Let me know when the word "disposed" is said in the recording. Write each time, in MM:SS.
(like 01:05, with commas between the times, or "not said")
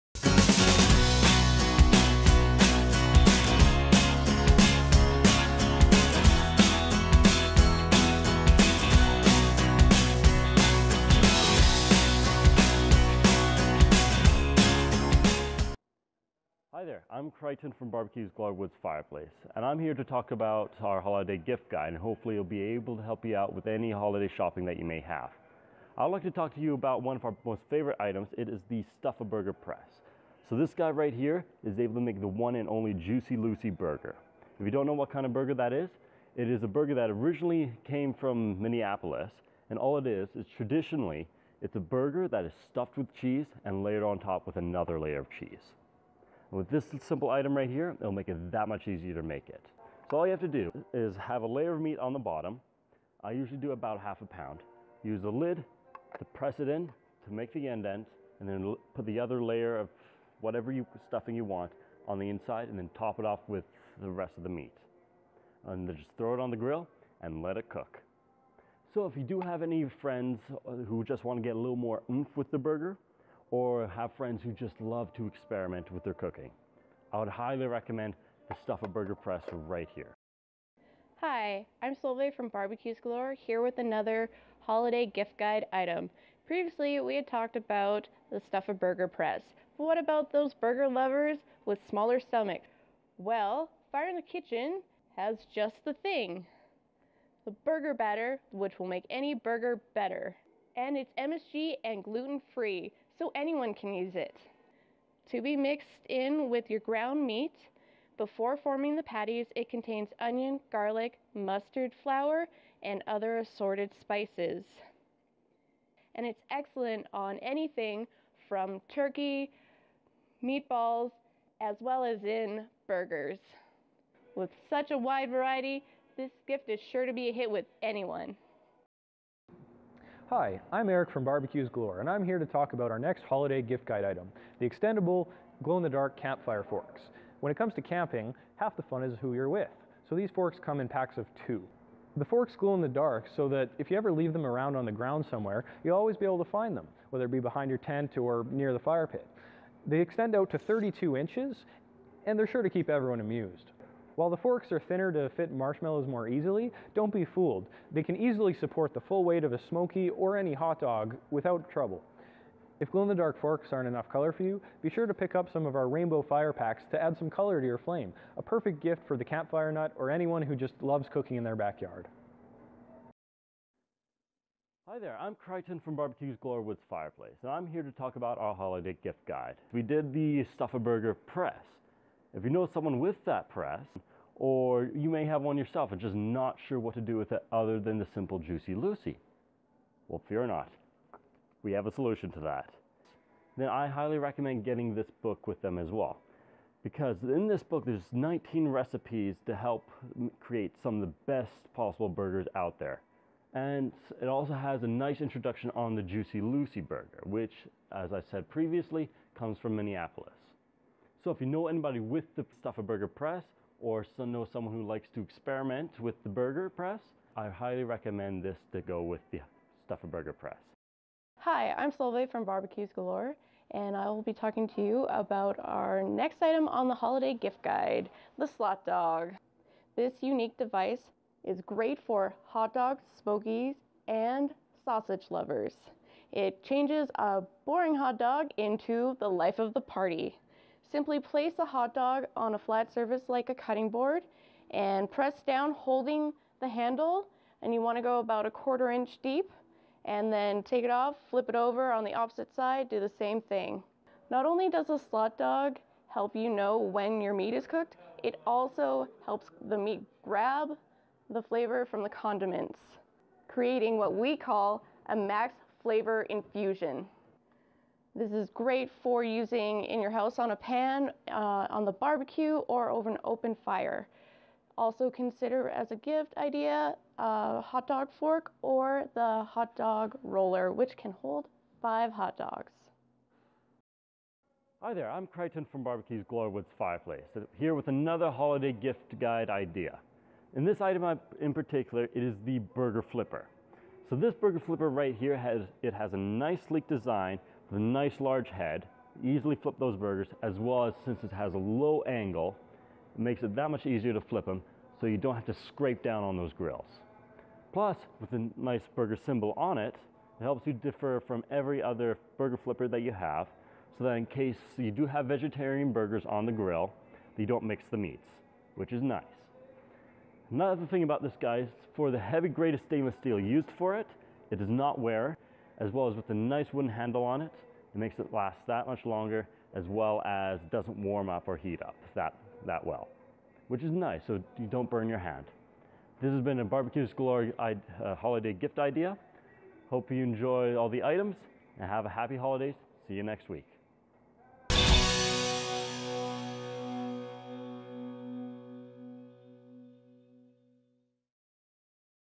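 not said.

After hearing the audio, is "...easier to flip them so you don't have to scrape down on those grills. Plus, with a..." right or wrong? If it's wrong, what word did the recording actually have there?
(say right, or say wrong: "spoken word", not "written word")
right.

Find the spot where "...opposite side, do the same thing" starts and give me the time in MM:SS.
04:12.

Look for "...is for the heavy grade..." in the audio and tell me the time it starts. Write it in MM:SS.
05:21.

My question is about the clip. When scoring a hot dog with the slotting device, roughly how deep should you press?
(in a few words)
A quarter inch.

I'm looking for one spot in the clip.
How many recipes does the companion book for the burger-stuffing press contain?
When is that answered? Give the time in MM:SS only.
03:18.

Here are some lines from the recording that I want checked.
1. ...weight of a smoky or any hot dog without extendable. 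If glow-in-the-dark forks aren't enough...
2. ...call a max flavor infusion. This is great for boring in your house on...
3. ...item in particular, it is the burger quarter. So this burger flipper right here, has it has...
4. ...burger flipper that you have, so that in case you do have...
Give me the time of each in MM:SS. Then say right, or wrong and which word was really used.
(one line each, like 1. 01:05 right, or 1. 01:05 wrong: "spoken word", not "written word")
1. 02:39 wrong: "trouble", not "extendable"
2. 04:24 wrong: "using", not "boring"
3. 04:50 wrong: "flipper", not "quarter"
4. 05:12 right.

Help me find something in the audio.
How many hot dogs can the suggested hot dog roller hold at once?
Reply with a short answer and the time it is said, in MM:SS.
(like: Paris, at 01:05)
5, at 04:41.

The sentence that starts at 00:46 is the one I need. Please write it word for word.
With this simple item right here, it'll make it that much easier to make it.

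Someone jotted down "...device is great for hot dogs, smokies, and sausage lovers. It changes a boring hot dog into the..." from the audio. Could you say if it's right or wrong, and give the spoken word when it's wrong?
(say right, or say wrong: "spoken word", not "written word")
right.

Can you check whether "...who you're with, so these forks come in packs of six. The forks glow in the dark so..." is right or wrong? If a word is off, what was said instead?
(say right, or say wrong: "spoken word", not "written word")
wrong: "two", not "six".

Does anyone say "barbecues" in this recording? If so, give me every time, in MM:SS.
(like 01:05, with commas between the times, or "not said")
00:17, 01:22, 02:11, 02:55, 03:42, 04:31, 04:45, 05:36.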